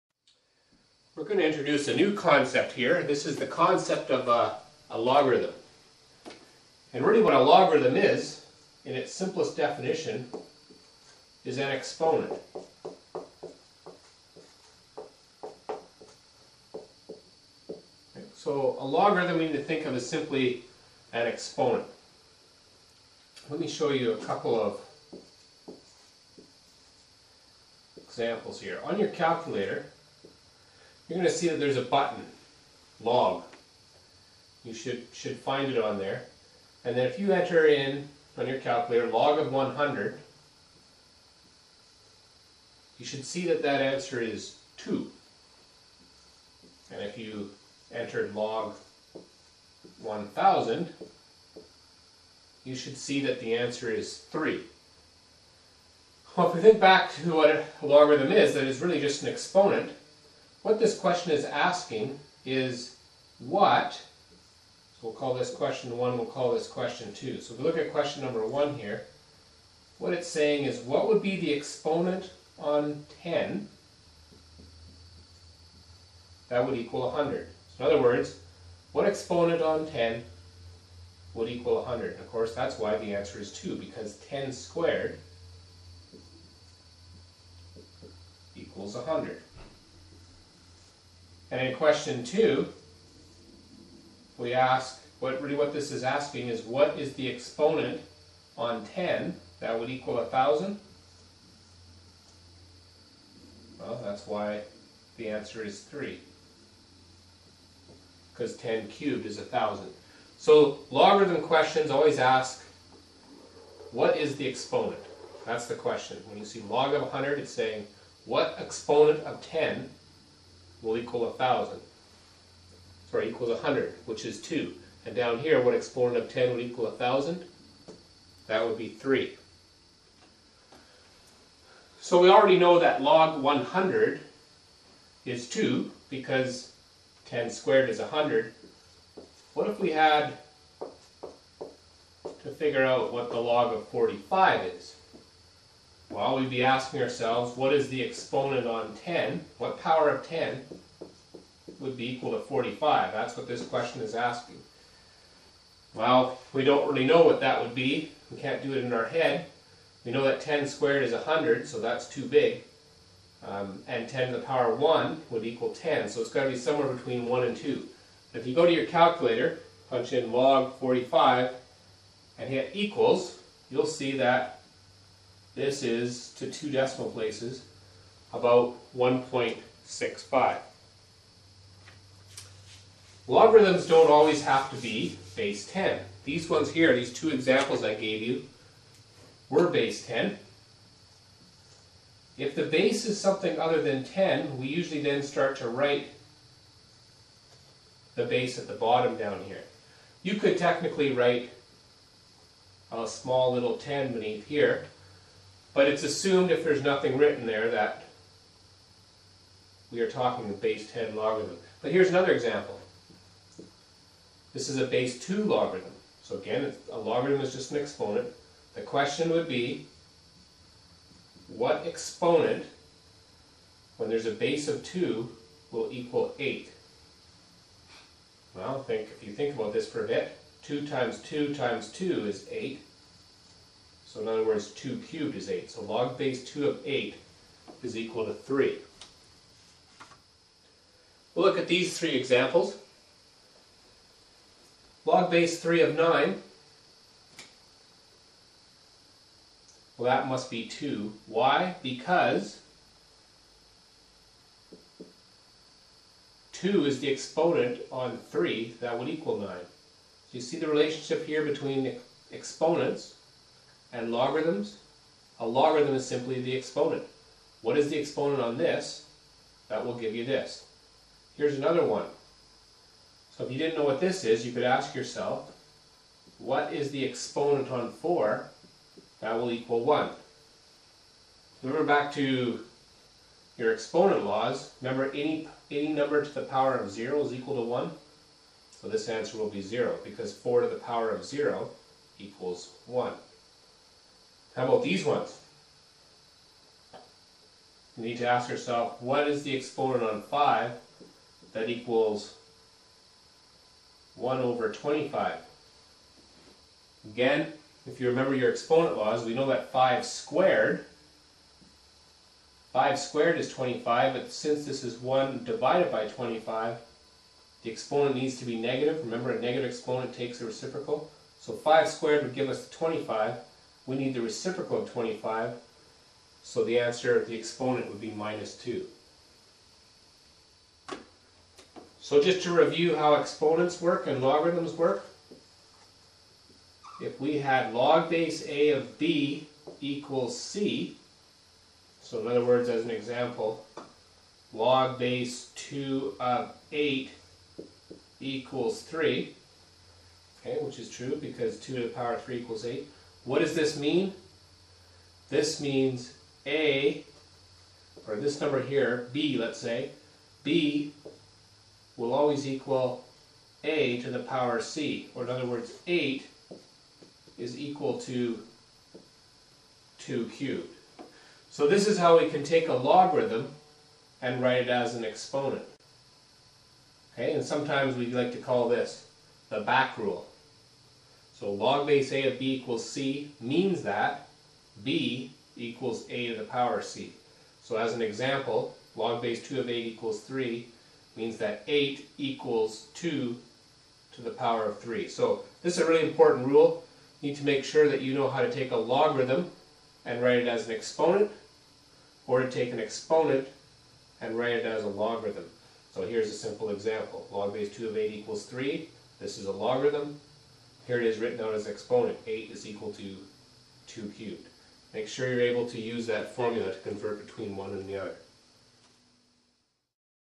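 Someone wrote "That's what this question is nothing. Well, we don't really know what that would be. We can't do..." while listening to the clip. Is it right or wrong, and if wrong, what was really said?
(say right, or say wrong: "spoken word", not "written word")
wrong: "asking", not "nothing".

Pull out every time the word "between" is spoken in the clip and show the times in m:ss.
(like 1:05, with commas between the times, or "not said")
2:46, 4:21, 6:57.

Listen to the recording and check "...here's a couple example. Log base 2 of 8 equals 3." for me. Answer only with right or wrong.
wrong.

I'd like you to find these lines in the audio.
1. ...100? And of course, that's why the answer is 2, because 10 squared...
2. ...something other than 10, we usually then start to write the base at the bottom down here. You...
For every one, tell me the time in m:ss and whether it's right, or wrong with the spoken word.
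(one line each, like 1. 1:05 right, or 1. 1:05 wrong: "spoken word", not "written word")
1. 1:21 right
2. 3:13 right.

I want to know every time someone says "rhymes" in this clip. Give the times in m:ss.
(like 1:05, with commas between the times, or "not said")
not said.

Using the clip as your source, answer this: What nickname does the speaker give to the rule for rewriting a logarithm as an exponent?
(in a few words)
the back rule.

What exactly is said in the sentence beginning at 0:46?
And if you entered log 1000, you should see that the answer is 3.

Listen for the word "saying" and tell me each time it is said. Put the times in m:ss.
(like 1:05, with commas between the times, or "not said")
1:10, 1:57.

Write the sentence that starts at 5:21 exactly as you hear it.
So 5 squared would give us 25.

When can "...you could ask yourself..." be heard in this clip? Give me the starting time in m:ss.
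4:34.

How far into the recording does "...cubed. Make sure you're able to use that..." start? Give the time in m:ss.
6:54.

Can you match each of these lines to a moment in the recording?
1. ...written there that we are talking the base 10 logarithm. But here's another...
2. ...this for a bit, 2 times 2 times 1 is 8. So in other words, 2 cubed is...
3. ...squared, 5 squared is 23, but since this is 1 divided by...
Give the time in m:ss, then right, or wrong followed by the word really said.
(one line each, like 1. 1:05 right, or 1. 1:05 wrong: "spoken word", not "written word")
1. 3:27 right
2. 3:49 wrong: "2", not "1"
3. 5:10 wrong: "25", not "23".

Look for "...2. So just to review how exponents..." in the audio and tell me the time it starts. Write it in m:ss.
5:28.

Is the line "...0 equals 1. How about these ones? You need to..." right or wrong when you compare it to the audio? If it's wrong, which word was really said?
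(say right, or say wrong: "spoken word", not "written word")
right.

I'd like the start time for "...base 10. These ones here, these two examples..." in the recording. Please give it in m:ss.
3:05.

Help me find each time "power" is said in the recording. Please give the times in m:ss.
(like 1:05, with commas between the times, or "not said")
2:29, 2:44, 4:46, 4:50, 5:51, 6:04, 6:26, 6:34.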